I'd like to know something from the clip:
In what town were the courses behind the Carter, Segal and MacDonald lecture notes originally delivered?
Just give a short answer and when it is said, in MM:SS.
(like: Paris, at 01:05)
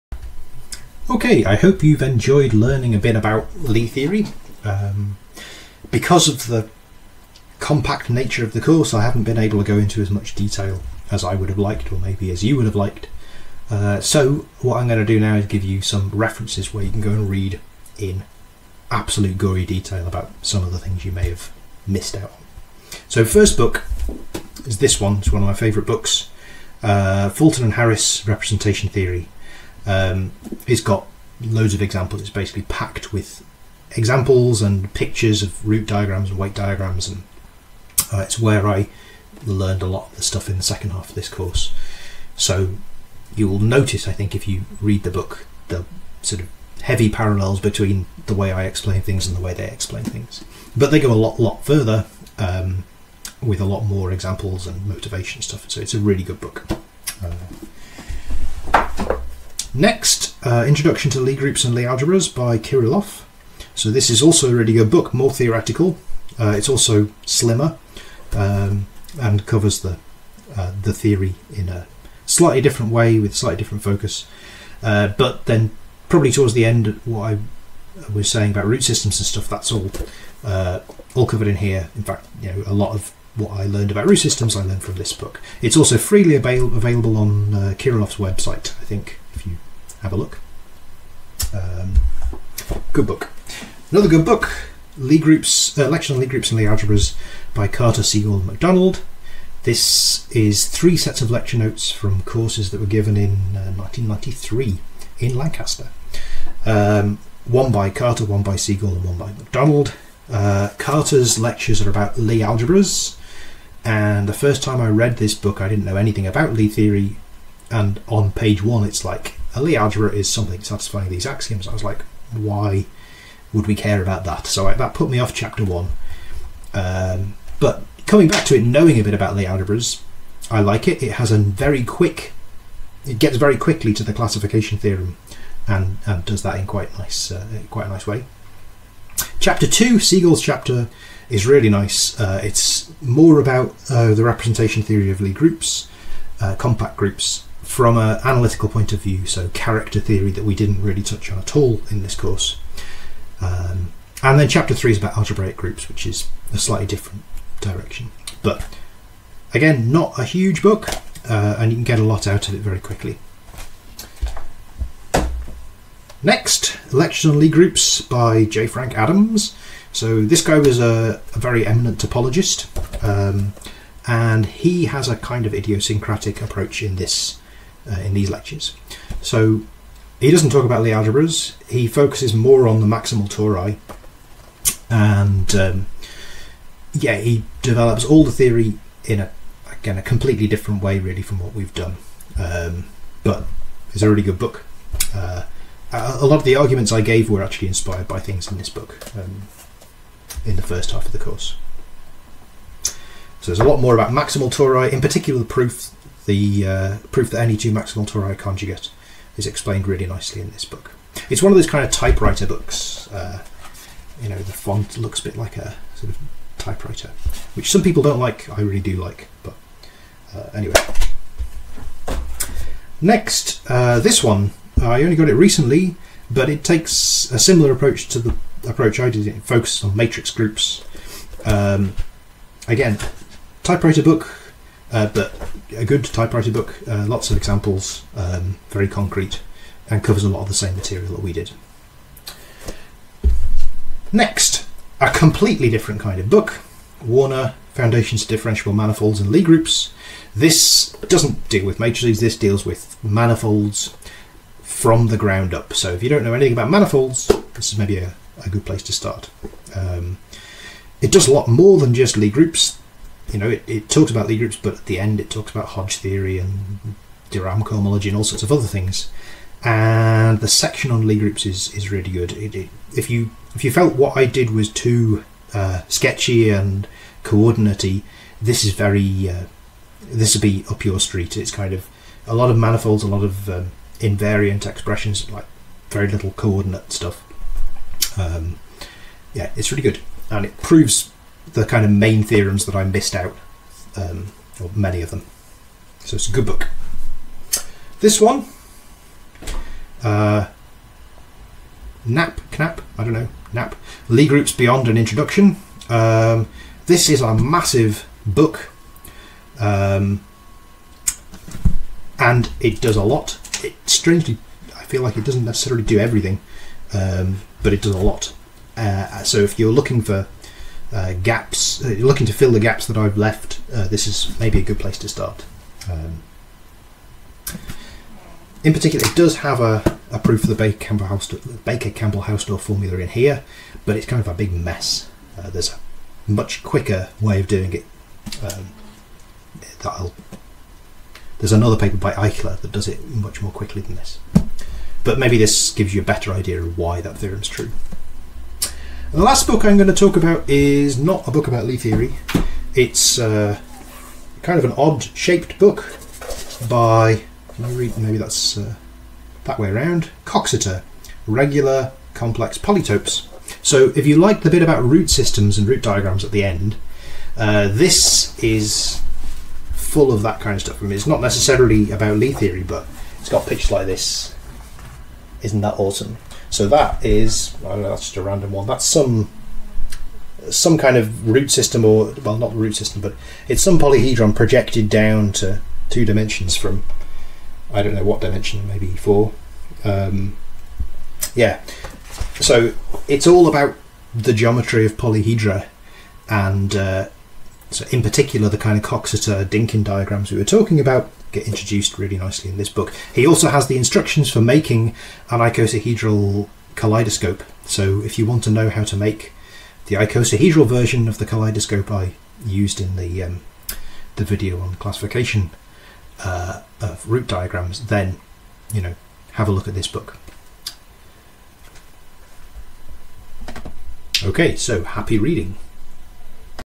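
Lancaster, at 01:45.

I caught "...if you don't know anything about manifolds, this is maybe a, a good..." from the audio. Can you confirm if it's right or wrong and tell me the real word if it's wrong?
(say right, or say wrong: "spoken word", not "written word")
right.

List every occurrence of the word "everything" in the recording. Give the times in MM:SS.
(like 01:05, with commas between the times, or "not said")
05:15.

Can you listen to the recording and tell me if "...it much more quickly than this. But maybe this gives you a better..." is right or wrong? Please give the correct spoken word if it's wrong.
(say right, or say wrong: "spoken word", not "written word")
right.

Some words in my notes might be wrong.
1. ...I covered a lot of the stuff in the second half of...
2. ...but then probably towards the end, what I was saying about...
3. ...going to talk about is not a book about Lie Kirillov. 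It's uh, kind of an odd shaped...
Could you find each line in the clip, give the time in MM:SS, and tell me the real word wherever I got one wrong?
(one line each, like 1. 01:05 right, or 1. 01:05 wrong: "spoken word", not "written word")
1. 00:38 wrong: "learned", not "covered"
2. 01:15 right
3. 05:49 wrong: "Theory", not "Kirillov".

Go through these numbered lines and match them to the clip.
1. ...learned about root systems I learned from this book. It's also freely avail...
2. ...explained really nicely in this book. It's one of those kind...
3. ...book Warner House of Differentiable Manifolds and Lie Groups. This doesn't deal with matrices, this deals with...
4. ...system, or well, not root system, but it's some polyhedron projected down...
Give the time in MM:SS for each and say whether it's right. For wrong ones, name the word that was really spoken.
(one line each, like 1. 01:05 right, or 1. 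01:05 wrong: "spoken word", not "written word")
1. 01:23 right
2. 03:29 right
3. 04:06 wrong: "Foundations", not "House"
4. 06:21 right.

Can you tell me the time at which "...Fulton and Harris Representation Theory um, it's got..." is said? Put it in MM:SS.
00:27.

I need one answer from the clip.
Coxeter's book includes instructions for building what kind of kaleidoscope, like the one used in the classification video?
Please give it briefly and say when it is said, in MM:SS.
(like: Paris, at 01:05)
Icosahedral kaleidoscope, at 06:45.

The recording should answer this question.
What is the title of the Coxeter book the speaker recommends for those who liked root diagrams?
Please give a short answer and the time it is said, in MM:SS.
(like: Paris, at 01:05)
Regular Complex Polytopes, at 06:01.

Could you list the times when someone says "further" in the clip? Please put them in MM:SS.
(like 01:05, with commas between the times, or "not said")
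00:51.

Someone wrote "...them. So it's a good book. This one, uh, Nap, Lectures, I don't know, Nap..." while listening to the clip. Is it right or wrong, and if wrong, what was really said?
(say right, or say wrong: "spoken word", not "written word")
wrong: "Knapp", not "Lectures".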